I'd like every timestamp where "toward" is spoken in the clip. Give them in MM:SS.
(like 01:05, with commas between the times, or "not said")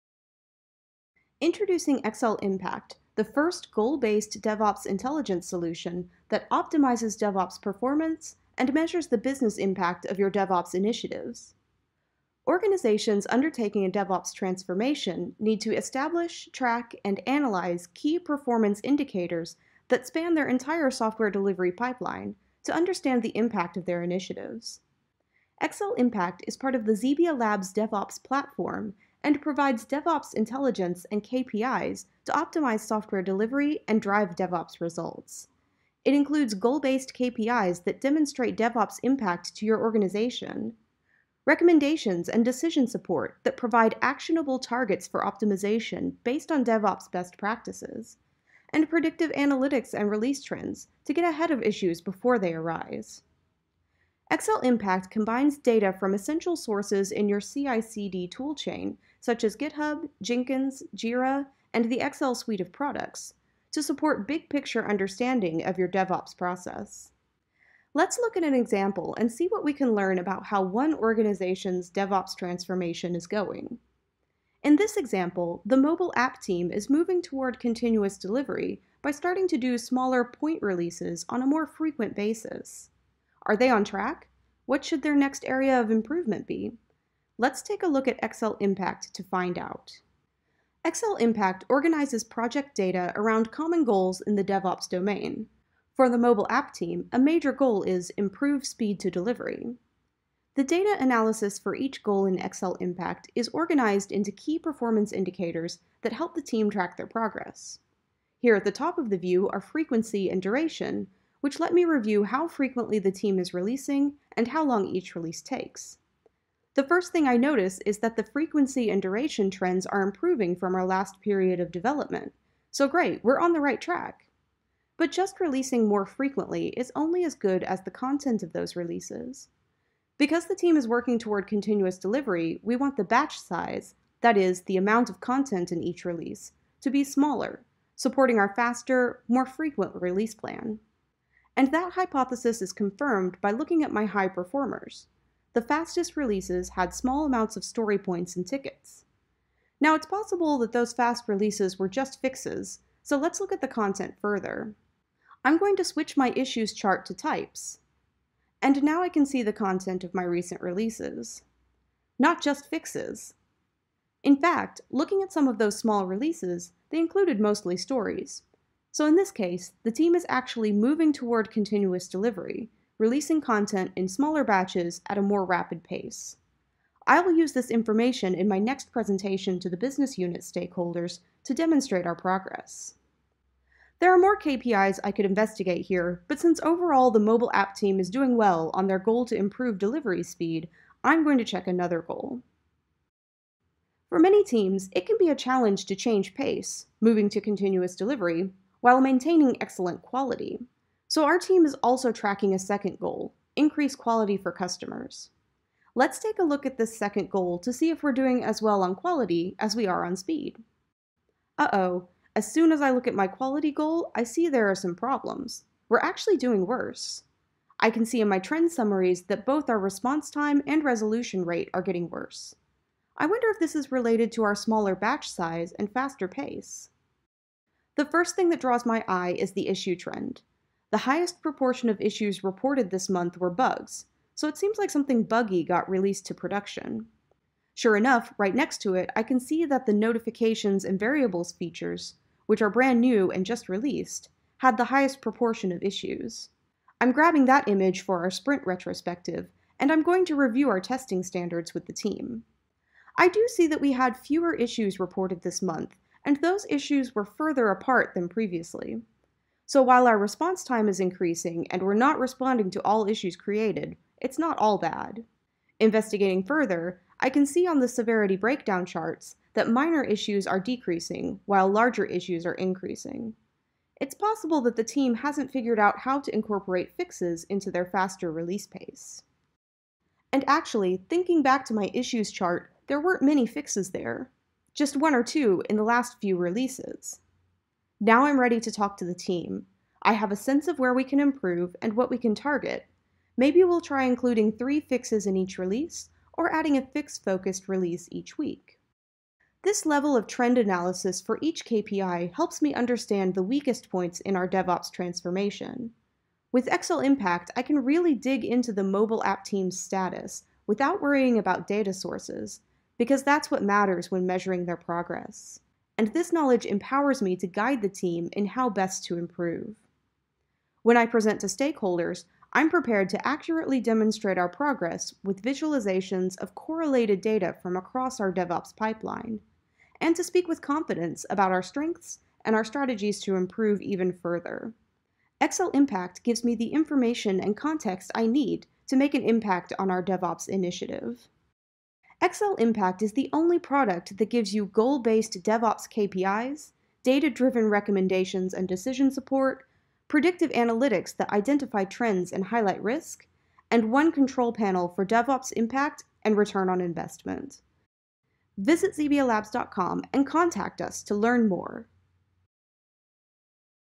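01:17, 02:11, 02:51.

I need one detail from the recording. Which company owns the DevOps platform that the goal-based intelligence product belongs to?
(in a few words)
XebiaLabs.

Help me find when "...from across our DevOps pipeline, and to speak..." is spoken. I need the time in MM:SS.
05:27.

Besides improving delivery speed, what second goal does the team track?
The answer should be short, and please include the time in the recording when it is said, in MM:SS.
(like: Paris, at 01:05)
increase quality for customers, at 03:23.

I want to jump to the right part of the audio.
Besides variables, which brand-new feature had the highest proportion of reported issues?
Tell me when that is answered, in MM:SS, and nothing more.
03:59.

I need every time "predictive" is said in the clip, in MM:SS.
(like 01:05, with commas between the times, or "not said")
00:48, 05:50.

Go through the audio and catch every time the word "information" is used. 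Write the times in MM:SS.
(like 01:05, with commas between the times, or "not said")
02:57, 05:36.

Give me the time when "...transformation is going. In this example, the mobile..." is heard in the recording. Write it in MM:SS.
01:12.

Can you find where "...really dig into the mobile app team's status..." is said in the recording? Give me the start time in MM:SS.
05:07.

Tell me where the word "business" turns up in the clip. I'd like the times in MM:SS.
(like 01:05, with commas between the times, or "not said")
00:09, 02:59.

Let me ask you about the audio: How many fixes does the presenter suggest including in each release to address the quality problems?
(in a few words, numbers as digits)
3.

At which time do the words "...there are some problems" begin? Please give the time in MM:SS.
03:34.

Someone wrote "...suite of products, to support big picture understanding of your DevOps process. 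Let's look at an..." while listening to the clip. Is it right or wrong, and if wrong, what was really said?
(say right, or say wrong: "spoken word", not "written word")
right.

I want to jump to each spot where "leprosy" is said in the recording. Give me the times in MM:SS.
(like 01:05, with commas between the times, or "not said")
not said.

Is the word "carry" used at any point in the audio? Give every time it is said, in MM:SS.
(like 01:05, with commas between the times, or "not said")
not said.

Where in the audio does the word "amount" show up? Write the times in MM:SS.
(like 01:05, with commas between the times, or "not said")
02:14, 02:27.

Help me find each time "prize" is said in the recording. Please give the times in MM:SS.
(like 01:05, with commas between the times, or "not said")
not said.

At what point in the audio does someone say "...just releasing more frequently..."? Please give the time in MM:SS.
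02:05.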